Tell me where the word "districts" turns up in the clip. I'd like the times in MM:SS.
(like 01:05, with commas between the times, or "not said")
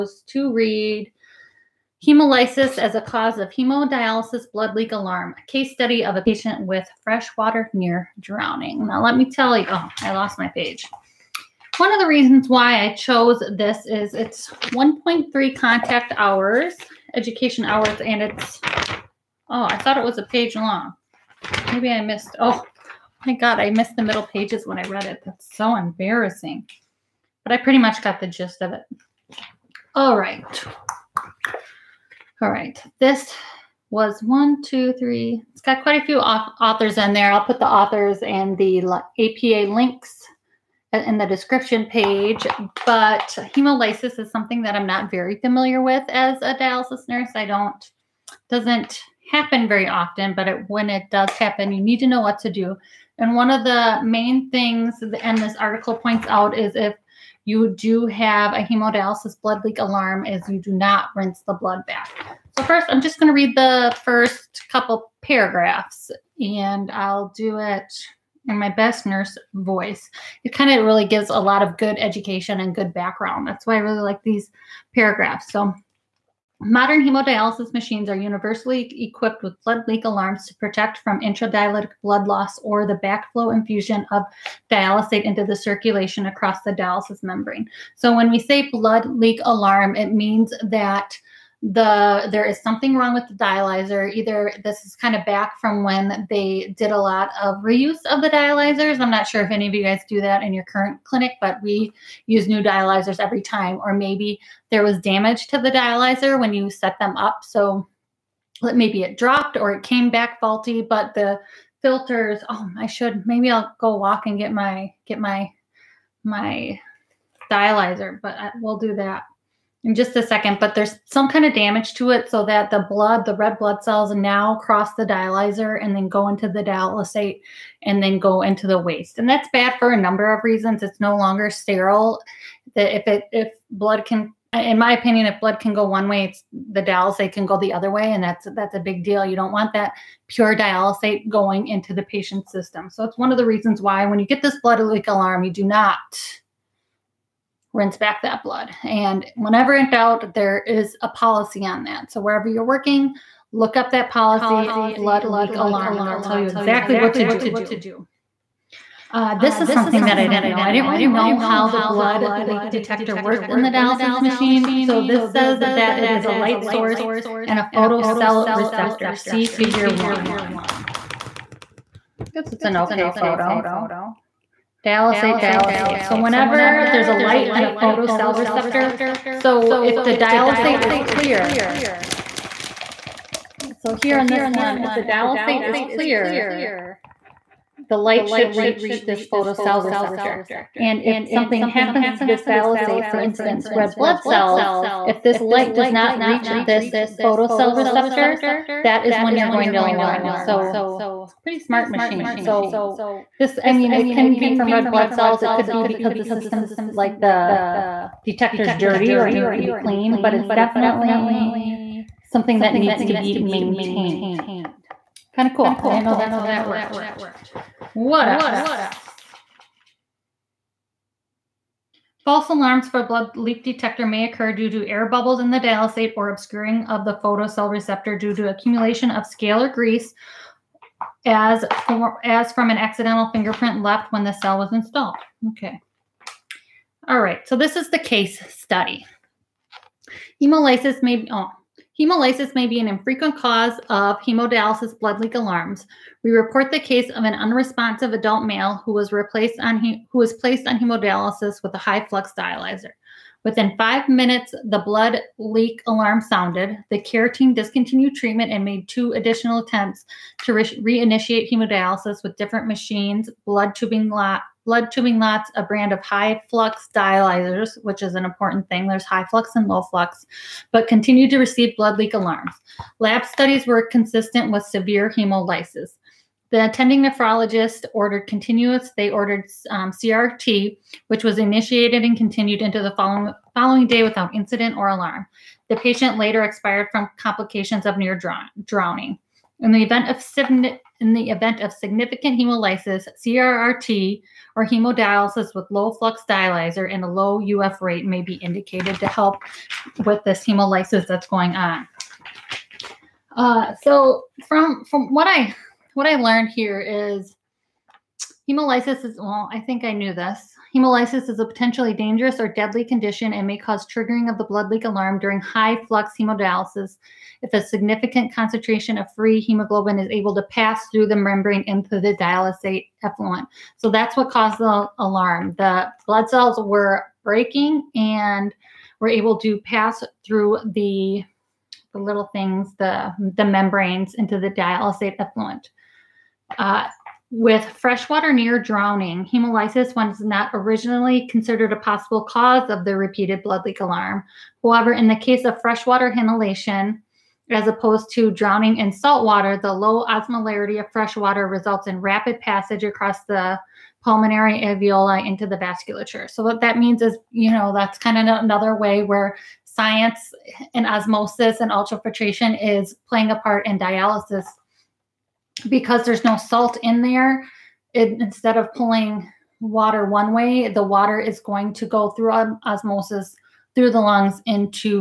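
not said.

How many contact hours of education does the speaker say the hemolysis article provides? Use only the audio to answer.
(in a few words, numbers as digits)
1.3.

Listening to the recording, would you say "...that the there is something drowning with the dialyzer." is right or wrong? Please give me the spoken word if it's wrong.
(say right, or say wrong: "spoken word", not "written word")
wrong: "wrong", not "drowning".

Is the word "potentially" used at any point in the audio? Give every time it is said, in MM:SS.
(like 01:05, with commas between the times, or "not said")
05:11.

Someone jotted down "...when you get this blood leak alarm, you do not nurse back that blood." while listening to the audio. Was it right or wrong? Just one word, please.
wrong.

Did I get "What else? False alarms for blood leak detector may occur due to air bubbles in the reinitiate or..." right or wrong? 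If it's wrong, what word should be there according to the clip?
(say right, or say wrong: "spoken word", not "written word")
wrong: "dialysate", not "reinitiate".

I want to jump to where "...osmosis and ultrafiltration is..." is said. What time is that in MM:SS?
06:00.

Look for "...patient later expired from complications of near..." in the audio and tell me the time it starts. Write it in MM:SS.
04:45.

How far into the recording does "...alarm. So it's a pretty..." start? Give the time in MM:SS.
03:19.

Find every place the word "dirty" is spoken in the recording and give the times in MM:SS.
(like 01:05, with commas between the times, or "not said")
03:28.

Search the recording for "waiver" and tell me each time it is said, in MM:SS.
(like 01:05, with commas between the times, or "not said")
not said.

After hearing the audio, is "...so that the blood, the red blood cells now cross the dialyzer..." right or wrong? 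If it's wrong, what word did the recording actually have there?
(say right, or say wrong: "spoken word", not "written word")
right.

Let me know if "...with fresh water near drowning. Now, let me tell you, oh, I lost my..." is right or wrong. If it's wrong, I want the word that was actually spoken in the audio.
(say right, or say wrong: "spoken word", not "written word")
right.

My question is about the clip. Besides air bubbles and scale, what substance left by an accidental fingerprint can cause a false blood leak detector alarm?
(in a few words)
grease.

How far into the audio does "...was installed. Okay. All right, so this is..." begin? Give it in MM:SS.
03:54.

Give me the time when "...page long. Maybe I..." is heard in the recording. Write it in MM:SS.
00:20.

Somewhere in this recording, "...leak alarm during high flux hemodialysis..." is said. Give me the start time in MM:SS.
05:14.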